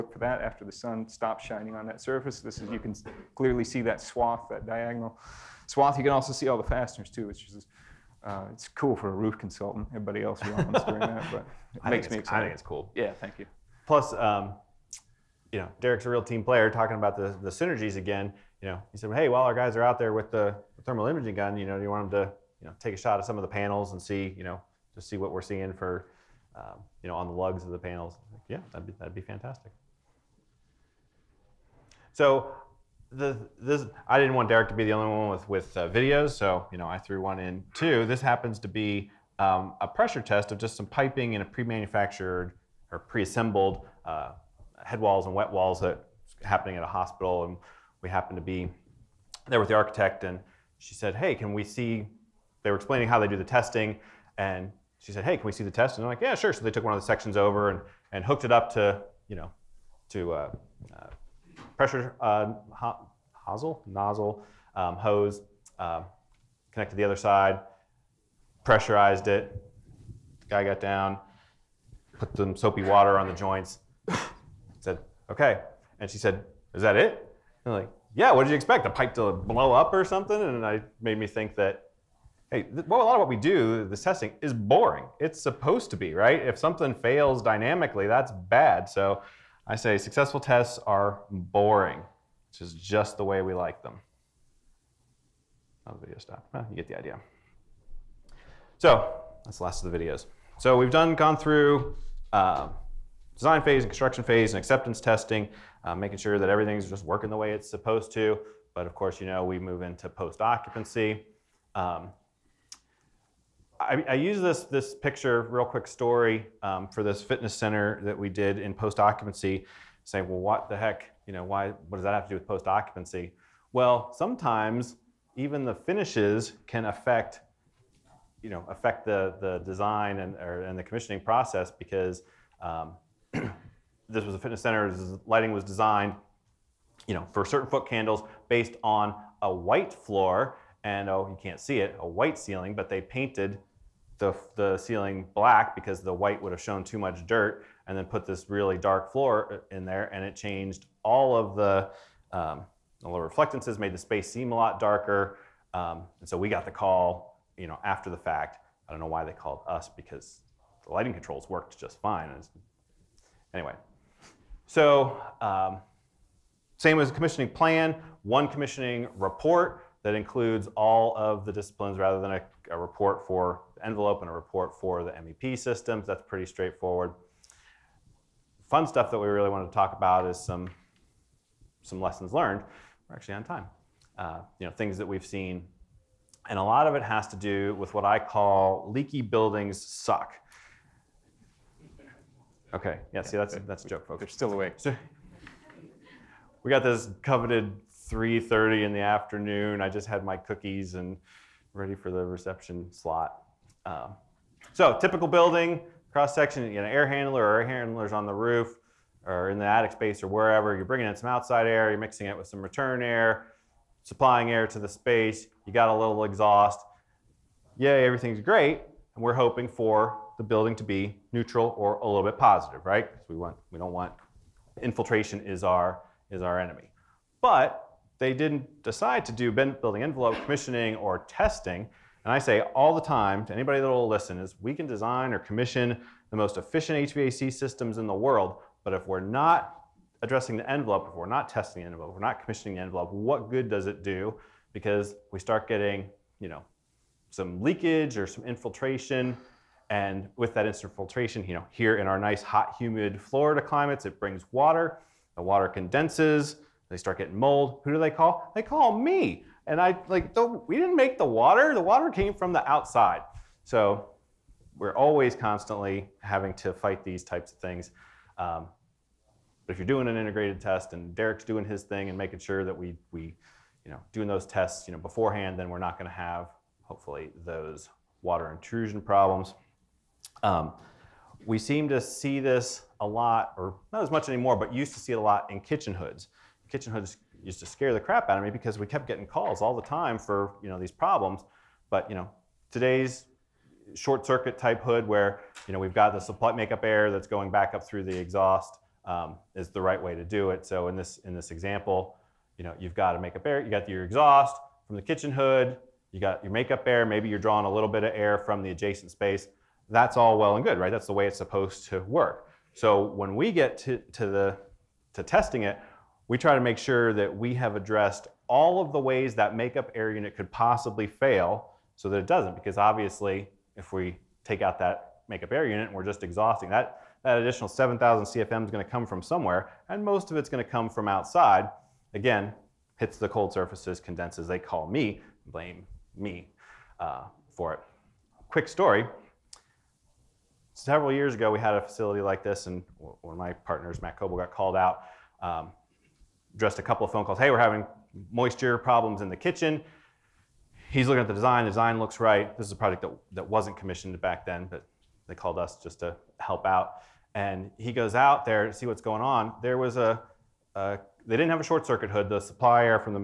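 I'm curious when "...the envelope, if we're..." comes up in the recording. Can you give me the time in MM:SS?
04:00.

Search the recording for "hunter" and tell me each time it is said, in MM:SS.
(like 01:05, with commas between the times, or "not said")
not said.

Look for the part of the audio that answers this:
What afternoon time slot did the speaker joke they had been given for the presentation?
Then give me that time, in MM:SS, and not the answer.
03:18.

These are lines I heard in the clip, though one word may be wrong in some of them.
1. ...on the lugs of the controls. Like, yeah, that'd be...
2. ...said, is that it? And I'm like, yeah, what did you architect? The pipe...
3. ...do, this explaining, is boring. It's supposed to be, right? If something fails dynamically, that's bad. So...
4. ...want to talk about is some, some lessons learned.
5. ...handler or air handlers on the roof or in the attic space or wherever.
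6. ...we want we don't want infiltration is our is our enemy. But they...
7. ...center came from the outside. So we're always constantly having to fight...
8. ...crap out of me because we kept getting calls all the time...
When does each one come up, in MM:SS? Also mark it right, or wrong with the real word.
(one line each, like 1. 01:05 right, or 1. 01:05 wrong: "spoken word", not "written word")
1. 00:27 wrong: "panels", not "controls"
2. 01:16 wrong: "expect", not "architect"
3. 01:23 wrong: "testing", not "explaining"
4. 02:59 right
5. 03:27 right
6. 03:43 right
7. 04:21 wrong: "water", not "center"
8. 04:47 right.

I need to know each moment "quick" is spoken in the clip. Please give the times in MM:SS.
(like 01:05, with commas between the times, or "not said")
01:55, 05:38.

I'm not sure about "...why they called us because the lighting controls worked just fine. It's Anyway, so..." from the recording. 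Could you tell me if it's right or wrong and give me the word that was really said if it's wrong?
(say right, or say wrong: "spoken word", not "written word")
right.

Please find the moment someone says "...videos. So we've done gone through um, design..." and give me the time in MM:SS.
01:39.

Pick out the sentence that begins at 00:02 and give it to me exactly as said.
This is you can clearly see that swath, that diagonal swath.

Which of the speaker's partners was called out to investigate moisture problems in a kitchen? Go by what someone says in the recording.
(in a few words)
Matt Coble.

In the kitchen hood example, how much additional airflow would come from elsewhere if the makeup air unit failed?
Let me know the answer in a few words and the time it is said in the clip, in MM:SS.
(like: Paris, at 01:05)
7,000 CFM, at 05:27.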